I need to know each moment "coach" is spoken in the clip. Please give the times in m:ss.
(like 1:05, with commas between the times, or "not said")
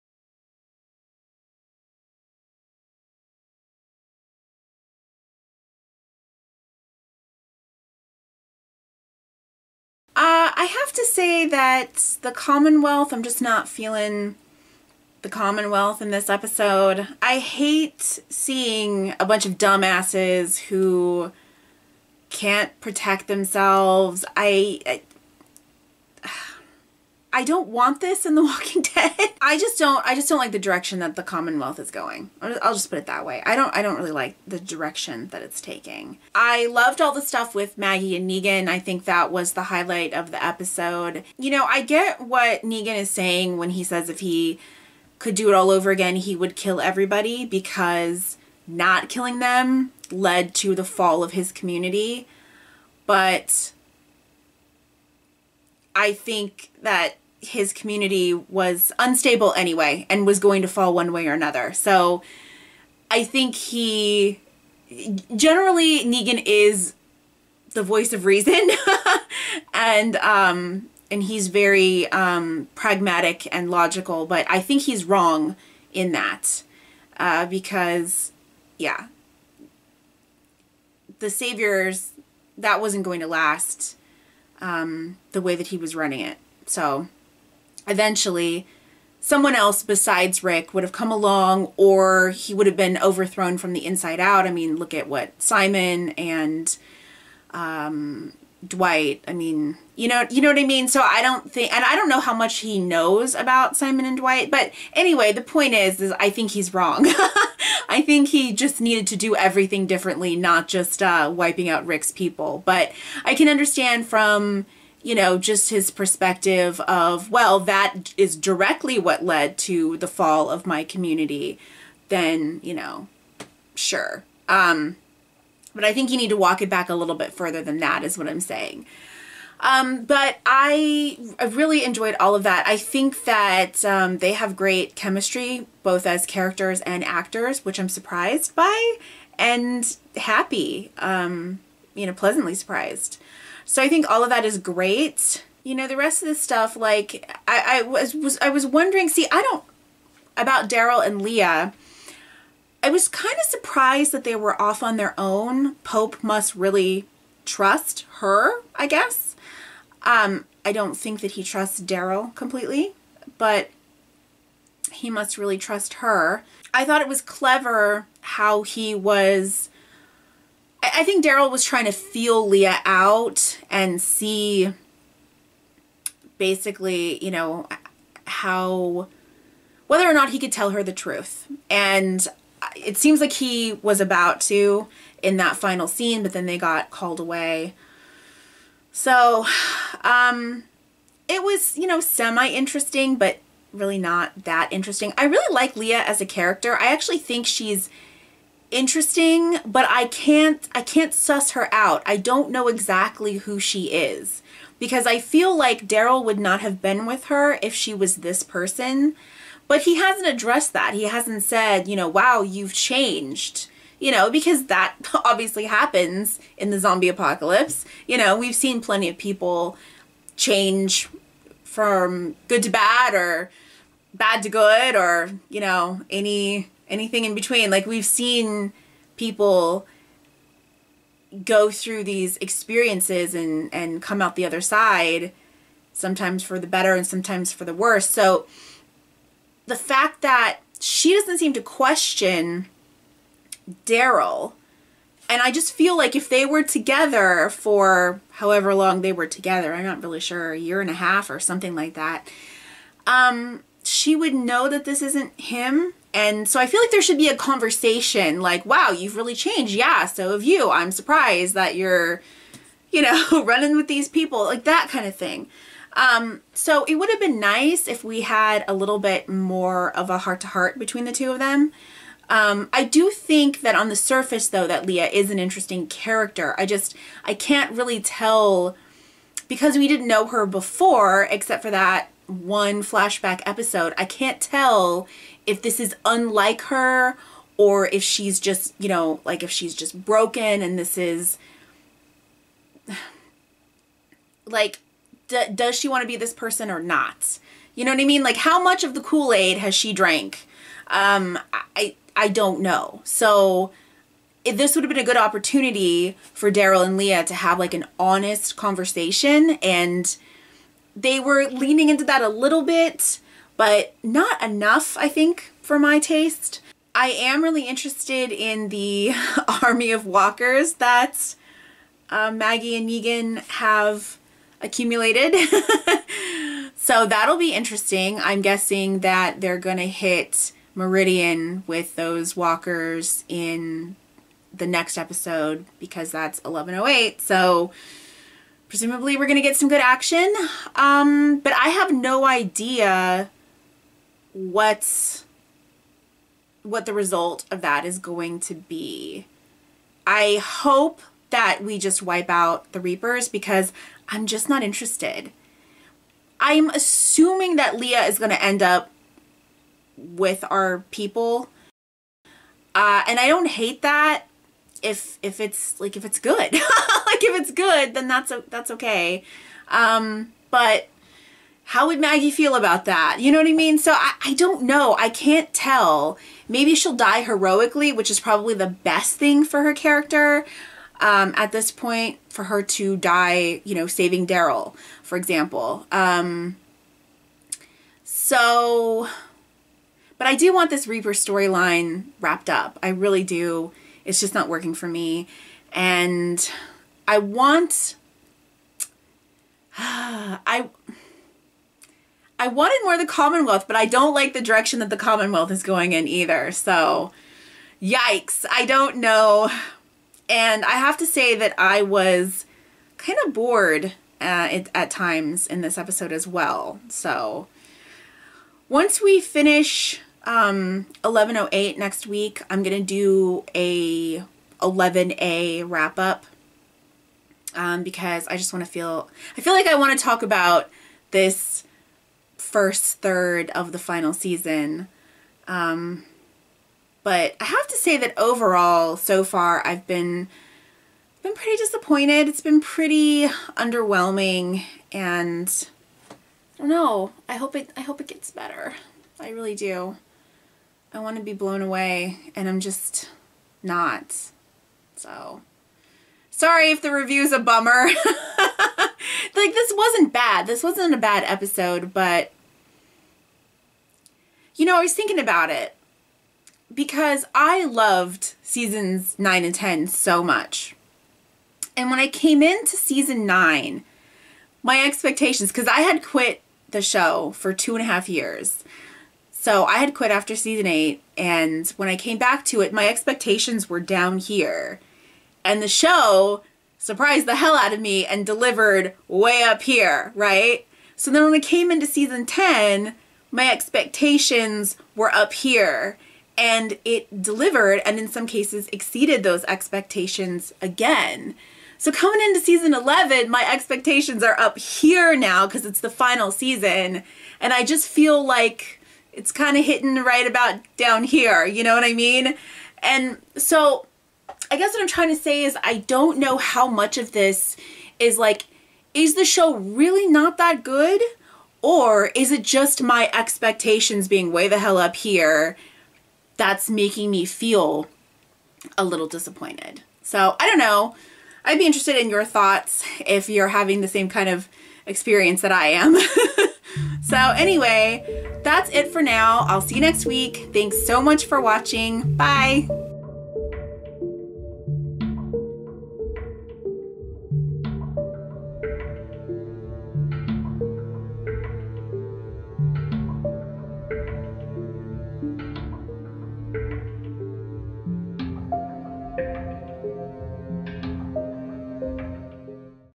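not said.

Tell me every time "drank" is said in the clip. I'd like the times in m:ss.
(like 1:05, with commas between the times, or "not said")
4:59.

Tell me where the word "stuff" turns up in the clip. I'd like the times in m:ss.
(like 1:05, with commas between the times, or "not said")
0:37, 2:26.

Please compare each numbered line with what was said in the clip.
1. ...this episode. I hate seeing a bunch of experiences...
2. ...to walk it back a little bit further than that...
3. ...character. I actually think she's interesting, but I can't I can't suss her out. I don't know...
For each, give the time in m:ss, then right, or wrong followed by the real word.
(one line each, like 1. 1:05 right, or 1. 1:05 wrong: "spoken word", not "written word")
1. 0:16 wrong: "dumbasses", not "experiences"
2. 2:06 right
3. 3:16 right.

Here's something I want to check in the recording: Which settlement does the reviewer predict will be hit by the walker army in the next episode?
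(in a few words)
Meridian.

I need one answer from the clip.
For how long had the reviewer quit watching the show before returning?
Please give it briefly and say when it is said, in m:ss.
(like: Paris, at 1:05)
two and a half years, at 7:57.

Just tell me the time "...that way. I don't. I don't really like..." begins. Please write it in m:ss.
0:33.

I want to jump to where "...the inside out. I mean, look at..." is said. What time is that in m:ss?
1:33.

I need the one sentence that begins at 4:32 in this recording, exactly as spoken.
Um, I do think that on the surface, though, that Leah is an interesting character.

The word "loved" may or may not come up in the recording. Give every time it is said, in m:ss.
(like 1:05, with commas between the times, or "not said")
0:36, 7:47.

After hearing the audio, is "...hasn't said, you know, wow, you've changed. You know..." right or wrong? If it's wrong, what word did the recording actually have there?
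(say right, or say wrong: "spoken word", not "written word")
right.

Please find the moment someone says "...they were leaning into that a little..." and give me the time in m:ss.
5:10.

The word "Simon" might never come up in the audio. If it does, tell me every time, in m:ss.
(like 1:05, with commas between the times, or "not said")
1:35, 1:43.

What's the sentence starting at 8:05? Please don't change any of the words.
And the show surprised the hell out of me and delivered way up here, right?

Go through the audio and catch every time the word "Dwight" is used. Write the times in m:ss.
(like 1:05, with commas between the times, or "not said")
1:38, 1:44.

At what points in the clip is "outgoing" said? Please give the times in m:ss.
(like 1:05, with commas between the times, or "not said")
not said.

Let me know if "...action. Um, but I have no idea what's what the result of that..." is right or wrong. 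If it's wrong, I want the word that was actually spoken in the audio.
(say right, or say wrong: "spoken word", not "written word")
right.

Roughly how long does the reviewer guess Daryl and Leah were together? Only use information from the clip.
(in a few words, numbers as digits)
a year and a half.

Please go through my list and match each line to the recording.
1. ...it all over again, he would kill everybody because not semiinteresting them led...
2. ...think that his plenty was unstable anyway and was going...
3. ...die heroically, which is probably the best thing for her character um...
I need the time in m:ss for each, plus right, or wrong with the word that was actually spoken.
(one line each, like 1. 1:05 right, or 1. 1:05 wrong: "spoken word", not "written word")
1. 0:45 wrong: "killing", not "semiinteresting"
2. 0:56 wrong: "community", not "plenty"
3. 6:16 right.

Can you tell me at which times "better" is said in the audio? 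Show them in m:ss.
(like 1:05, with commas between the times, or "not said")
3:56, 7:28.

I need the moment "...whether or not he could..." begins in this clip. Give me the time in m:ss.
2:59.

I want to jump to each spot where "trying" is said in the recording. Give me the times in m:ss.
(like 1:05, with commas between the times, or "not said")
2:51, 8:34.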